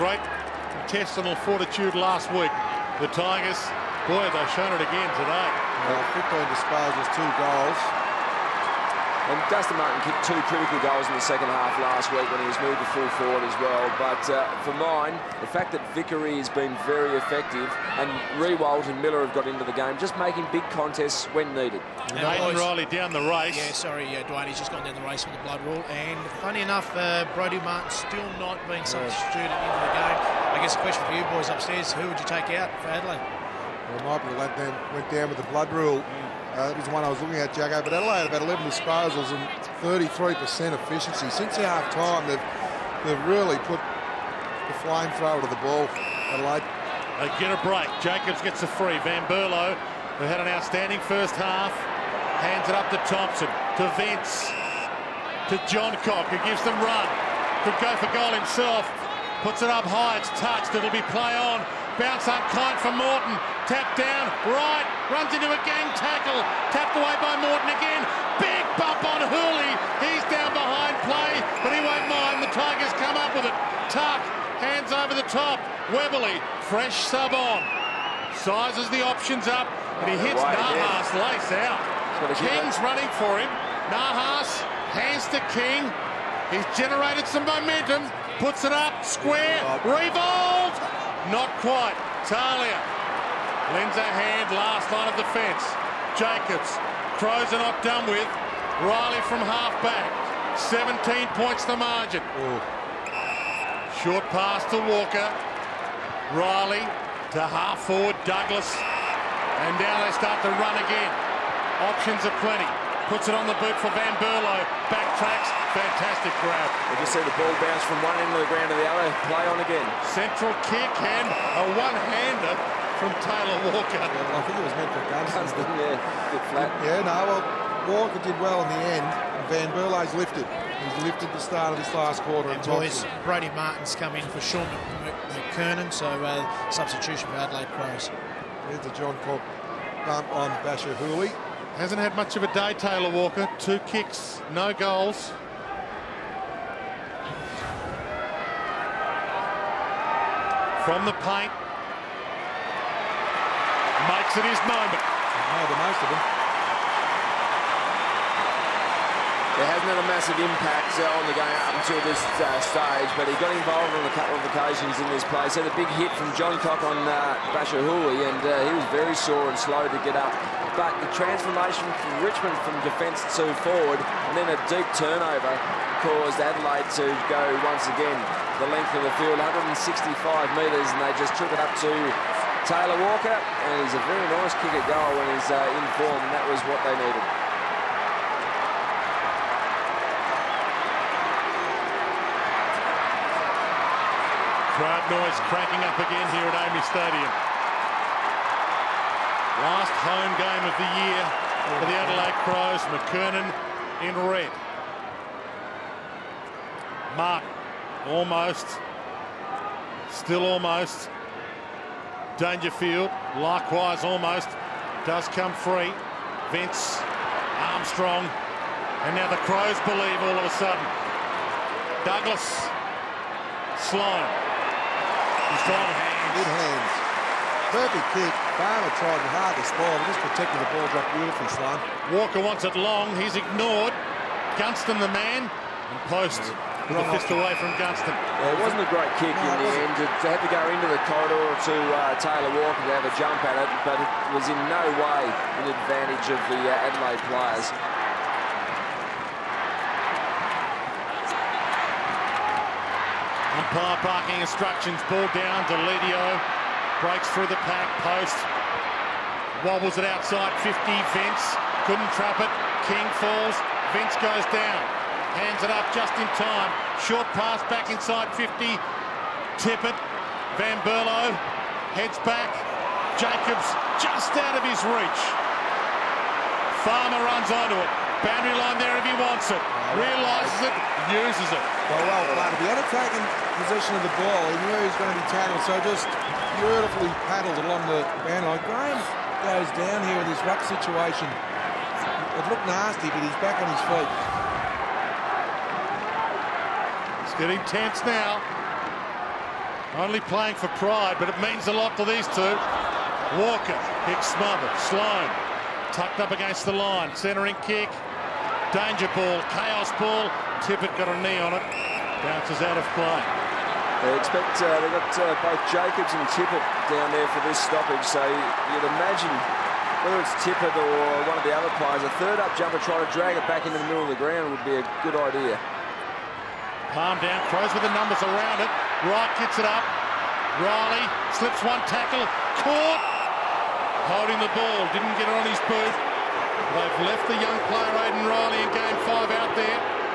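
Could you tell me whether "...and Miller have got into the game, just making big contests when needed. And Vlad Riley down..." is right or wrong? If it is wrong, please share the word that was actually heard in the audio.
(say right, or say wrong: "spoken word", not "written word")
wrong: "Aidan", not "Vlad".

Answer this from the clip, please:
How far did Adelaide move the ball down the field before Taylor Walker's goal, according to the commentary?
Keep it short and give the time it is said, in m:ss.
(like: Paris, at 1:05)
165 metres, at 2:59.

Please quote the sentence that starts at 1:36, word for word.
Jacobs Crows are not done with.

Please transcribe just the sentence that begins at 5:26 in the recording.
Palm down, throws with the numbers around it.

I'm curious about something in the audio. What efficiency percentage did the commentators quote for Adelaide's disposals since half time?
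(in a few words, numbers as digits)
33%.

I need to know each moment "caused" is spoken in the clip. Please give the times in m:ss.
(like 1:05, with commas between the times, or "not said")
2:56.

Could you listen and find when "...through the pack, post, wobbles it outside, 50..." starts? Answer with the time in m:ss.
4:17.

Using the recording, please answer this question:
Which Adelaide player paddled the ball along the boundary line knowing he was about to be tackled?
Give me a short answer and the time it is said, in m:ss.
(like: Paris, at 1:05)
Farmer, at 4:36.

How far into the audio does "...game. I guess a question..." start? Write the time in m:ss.
0:29.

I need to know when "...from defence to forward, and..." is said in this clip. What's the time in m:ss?
2:52.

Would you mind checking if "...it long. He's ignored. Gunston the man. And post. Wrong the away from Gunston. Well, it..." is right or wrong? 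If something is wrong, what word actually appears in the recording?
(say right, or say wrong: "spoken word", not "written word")
right.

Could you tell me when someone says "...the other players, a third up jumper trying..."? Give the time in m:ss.
5:21.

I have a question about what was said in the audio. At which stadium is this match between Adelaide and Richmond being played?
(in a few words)
AAMI Stadium.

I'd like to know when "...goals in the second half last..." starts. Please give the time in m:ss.
0:10.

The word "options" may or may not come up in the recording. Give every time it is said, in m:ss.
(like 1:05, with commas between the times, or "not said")
1:19, 1:51.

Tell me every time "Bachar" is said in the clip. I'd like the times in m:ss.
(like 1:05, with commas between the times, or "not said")
2:20, 2:47.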